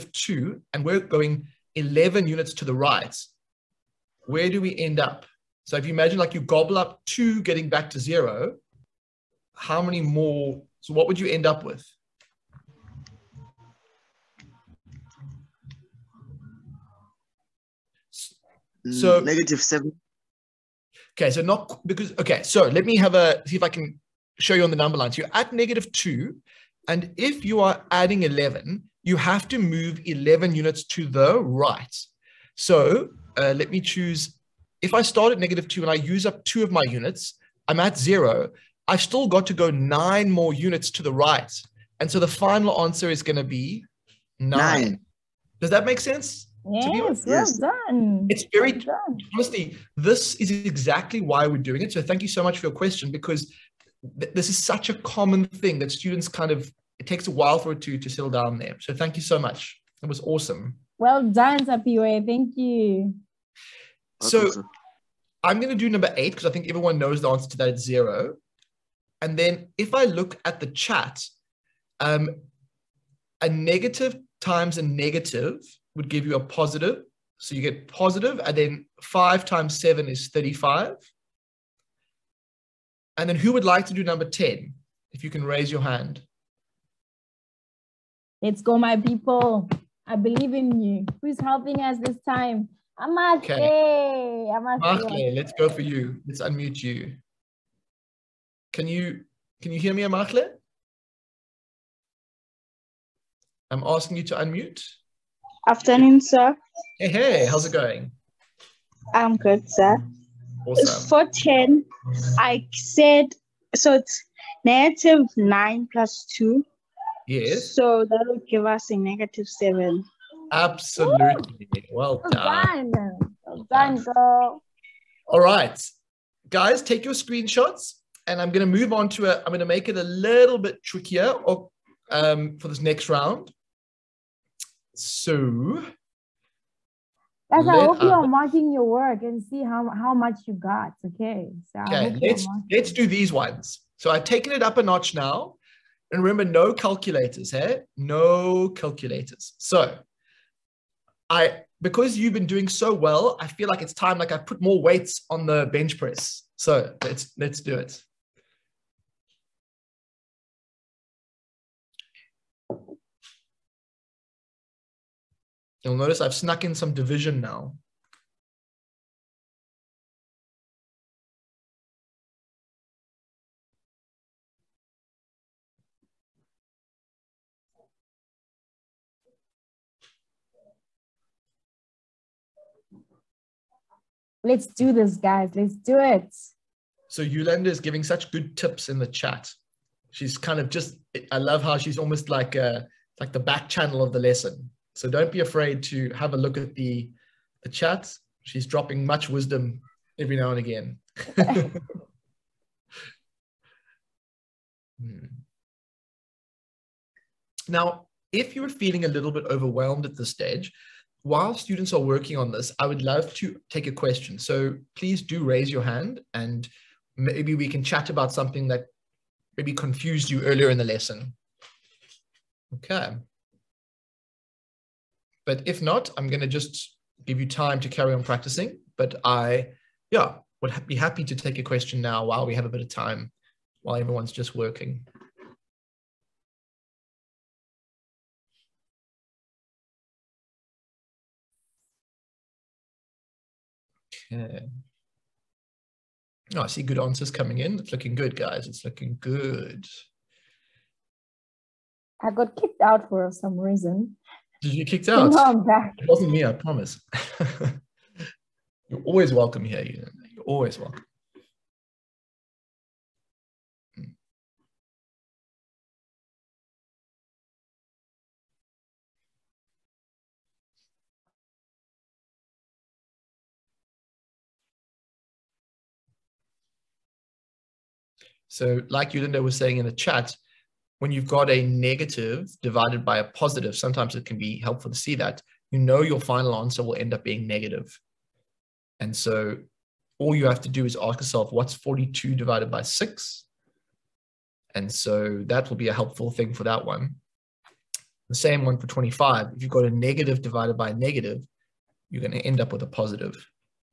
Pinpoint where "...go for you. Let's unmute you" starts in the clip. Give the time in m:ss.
1:35.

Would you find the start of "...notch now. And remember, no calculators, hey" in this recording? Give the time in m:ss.
2:24.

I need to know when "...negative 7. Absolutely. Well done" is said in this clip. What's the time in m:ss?
1:58.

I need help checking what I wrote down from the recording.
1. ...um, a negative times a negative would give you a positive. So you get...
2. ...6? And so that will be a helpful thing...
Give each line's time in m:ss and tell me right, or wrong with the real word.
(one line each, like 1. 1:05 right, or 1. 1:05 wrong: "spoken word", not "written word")
1. 1:11 right
2. 4:52 right.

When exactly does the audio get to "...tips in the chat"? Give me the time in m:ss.
3:08.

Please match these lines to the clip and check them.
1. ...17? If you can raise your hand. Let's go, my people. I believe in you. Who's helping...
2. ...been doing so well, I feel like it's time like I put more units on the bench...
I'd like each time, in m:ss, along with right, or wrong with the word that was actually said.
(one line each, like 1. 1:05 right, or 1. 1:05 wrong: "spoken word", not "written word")
1. 1:24 wrong: "10", not "17"
2. 2:32 wrong: "weights", not "units".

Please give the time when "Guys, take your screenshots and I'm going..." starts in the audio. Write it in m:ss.
2:06.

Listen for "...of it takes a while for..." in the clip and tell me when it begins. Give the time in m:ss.
0:56.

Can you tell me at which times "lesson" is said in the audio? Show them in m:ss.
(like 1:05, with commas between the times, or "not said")
3:14, 3:40.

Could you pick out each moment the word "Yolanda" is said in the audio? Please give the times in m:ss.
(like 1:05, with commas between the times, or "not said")
3:07, 4:39.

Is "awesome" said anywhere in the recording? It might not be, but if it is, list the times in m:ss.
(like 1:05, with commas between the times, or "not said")
1:00, 1:50.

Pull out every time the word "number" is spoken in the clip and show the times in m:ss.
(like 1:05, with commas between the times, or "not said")
0:24, 1:05, 1:24.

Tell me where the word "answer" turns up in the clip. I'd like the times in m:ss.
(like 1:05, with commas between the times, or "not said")
0:42, 1:07, 4:06, 4:46.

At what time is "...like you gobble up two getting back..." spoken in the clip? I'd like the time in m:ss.
0:06.